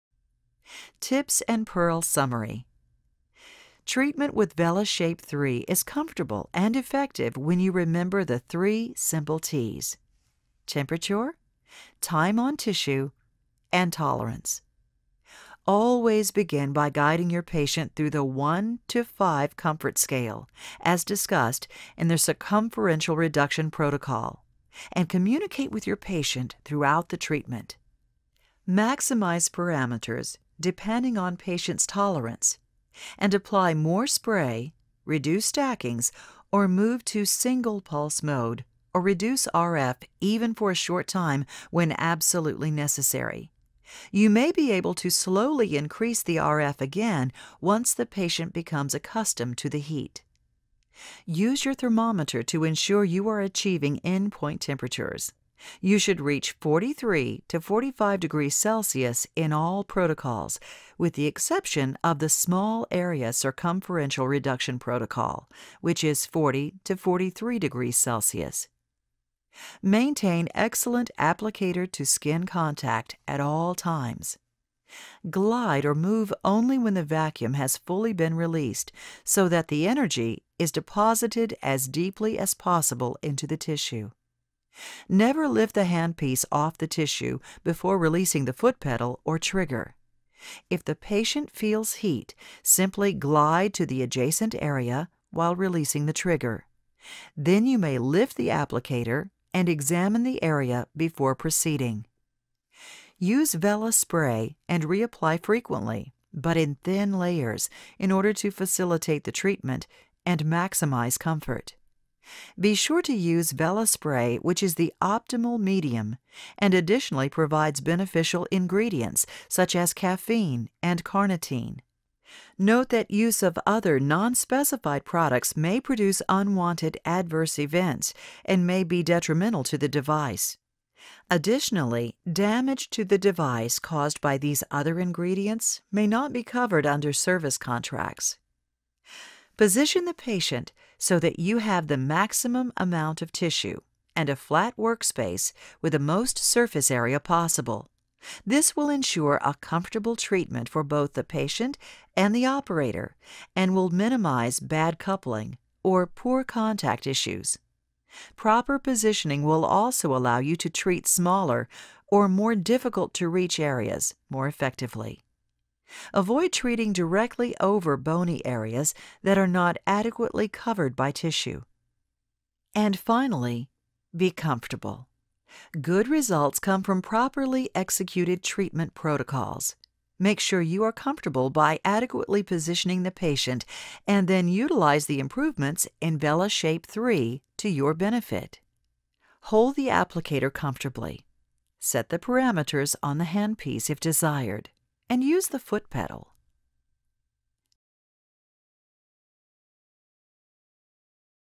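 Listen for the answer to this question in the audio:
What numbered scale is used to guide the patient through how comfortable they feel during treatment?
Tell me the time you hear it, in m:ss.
0:18.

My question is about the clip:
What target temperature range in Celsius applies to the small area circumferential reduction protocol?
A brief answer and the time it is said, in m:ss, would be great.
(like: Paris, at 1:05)
40 to 43, at 1:06.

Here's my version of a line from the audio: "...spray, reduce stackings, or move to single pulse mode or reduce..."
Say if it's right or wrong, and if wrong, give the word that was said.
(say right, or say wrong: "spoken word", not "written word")
right.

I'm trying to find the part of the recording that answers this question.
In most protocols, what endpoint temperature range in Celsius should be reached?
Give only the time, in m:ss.
0:56.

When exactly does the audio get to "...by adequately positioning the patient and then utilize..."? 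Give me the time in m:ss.
3:01.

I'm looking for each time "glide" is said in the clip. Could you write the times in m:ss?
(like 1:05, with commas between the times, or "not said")
1:15, 1:33.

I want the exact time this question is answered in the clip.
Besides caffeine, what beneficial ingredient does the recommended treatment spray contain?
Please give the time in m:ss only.
2:01.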